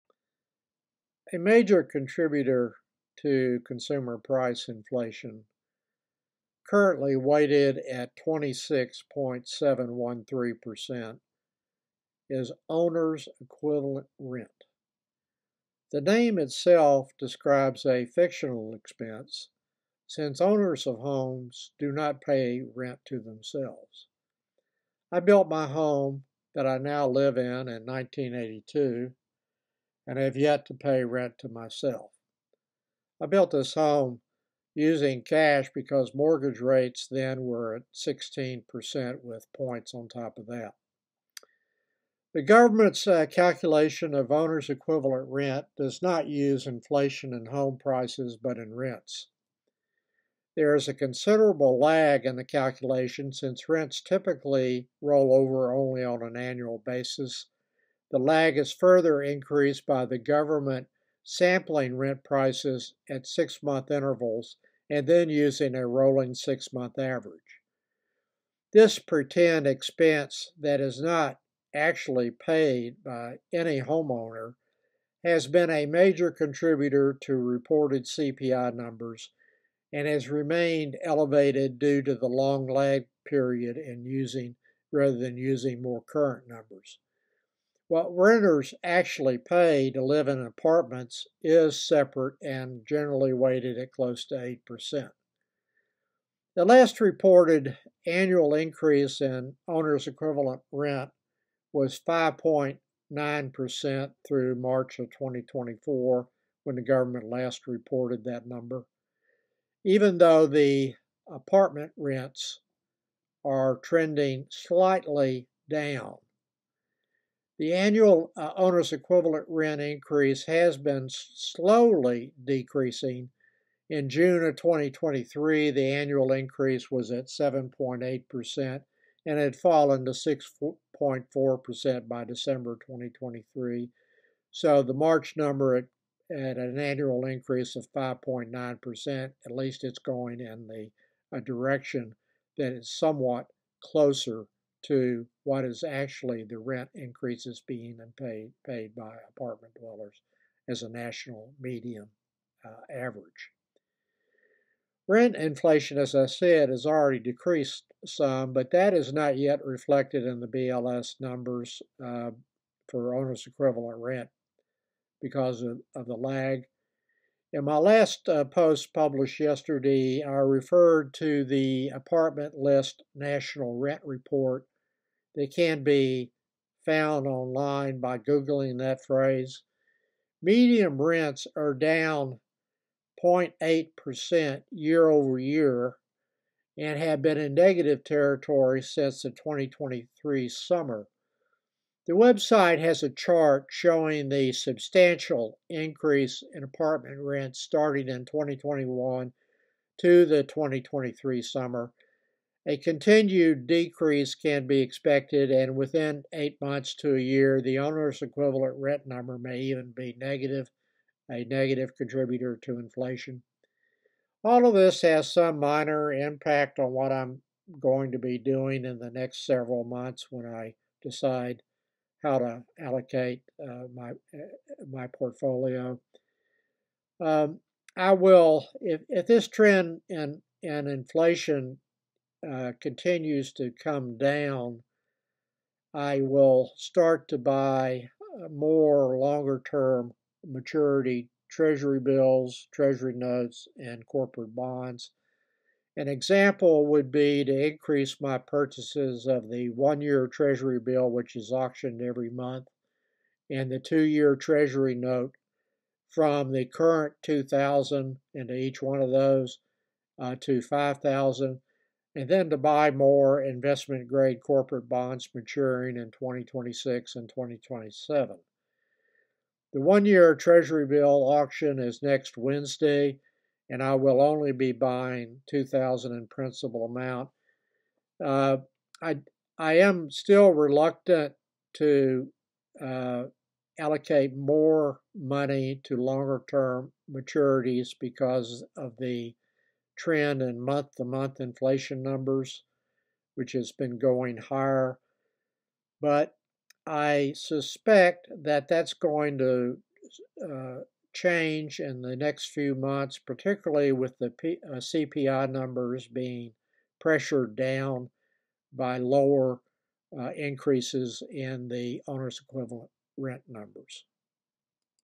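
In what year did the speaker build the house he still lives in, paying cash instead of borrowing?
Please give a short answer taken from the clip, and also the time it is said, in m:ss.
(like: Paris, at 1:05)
1982, at 0:27.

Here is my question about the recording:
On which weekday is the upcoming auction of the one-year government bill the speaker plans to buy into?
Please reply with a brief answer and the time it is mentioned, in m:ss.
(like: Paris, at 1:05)
Wednesday, at 4:32.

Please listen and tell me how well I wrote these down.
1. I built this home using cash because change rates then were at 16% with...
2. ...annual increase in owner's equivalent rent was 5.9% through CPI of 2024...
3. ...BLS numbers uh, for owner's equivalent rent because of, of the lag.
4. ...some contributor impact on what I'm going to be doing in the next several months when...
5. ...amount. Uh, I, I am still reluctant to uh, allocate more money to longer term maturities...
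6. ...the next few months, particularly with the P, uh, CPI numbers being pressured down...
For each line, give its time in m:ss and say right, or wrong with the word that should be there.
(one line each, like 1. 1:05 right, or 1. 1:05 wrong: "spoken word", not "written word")
1. 0:33 wrong: "mortgage", not "change"
2. 1:38 wrong: "March", not "CPI"
3. 2:40 right
4. 3:35 wrong: "minor", not "contributor"
5. 4:36 right
6. 5:02 right.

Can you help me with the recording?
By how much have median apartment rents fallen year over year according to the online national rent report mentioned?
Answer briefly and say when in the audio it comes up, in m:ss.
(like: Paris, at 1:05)
0.8%, at 3:03.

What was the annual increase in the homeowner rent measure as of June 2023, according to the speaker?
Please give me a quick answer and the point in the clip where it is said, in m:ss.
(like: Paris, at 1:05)
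7.8%, at 2:07.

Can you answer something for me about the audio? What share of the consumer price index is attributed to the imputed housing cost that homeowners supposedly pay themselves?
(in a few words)
26.713%.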